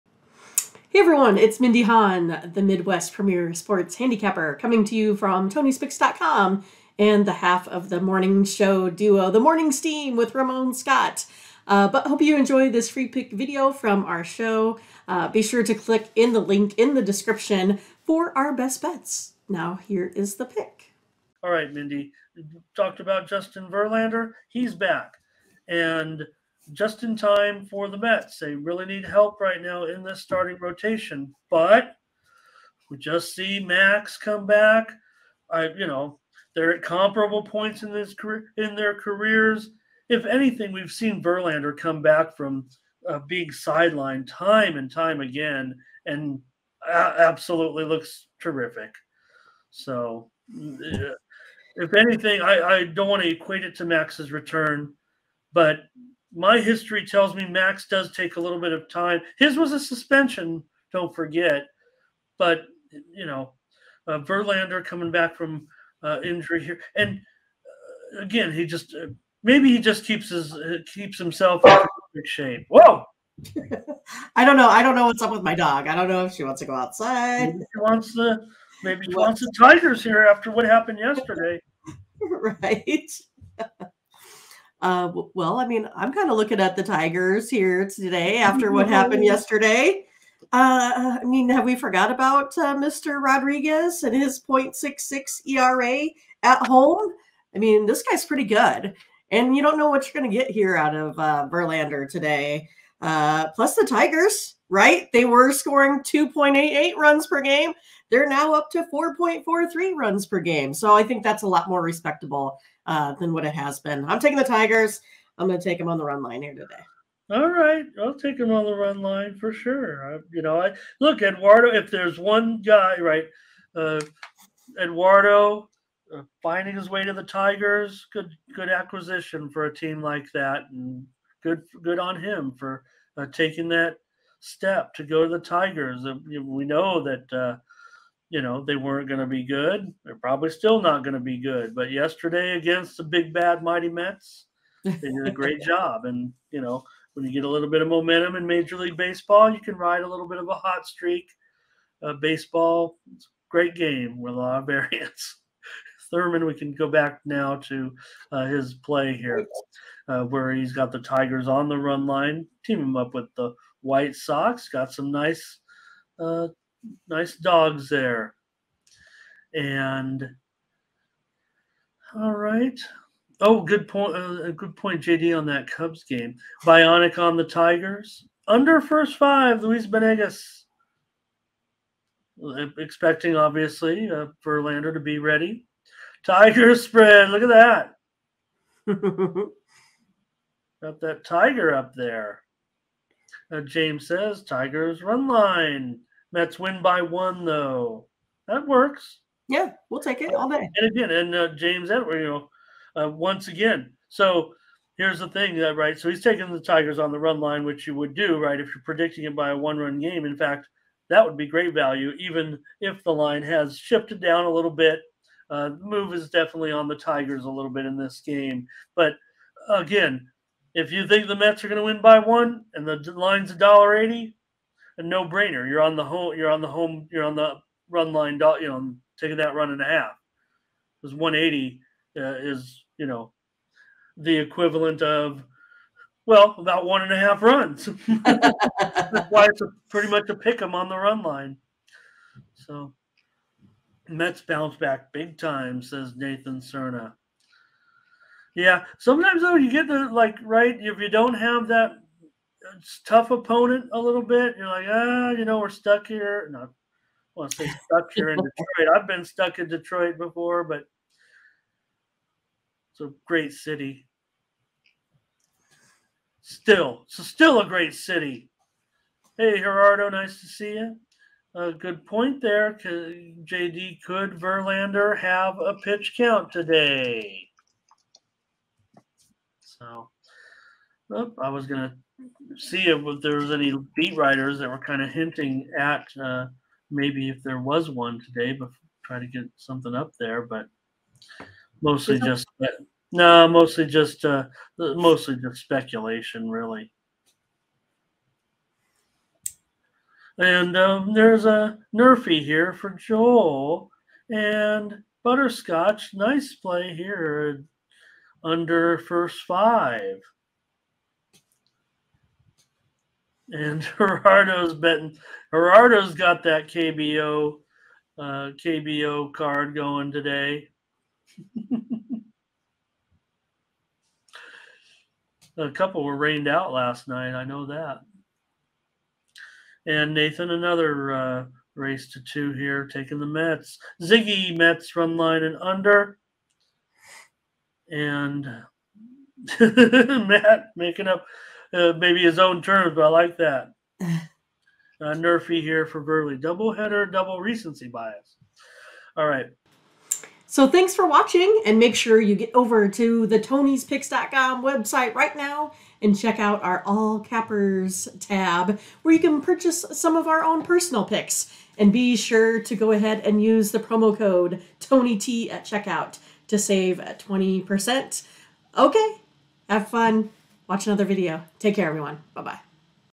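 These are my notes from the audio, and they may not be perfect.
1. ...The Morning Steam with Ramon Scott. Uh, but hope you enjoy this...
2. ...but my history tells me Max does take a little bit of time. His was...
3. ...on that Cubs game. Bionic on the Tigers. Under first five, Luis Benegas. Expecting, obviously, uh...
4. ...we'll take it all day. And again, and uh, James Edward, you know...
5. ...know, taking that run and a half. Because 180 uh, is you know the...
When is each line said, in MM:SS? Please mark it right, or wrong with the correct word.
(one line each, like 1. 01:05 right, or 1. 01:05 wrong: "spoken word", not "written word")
1. 00:09 right
2. 00:55 right
3. 02:55 right
4. 03:19 right
5. 03:48 right.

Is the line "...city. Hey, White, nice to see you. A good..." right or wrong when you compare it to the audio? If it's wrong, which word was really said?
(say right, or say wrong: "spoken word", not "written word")
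wrong: "Gerardo", not "White".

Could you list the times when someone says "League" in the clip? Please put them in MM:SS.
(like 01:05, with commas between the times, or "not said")
02:28.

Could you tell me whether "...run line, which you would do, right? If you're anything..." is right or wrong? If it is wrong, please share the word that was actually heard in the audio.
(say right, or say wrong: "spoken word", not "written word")
wrong: "predicting", not "anything".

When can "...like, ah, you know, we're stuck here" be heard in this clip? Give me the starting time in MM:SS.
04:14.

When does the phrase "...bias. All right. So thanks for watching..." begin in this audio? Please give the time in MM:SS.
05:47.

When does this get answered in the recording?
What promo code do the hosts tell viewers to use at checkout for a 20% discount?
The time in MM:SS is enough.
06:04.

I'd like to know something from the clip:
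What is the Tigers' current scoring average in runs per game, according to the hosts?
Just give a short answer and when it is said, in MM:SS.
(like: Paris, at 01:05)
4.43, at 01:48.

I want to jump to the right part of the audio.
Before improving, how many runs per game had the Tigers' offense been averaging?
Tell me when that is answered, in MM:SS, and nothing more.
01:46.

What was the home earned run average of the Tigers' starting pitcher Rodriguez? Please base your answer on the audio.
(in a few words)
0.66.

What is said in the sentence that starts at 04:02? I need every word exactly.
So Mets bounce back big time, says Nathan Cerna.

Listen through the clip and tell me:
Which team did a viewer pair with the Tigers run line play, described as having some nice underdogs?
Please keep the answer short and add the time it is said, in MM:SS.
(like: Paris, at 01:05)
White Sox, at 02:43.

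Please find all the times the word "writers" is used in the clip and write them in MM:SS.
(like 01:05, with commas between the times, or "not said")
04:44.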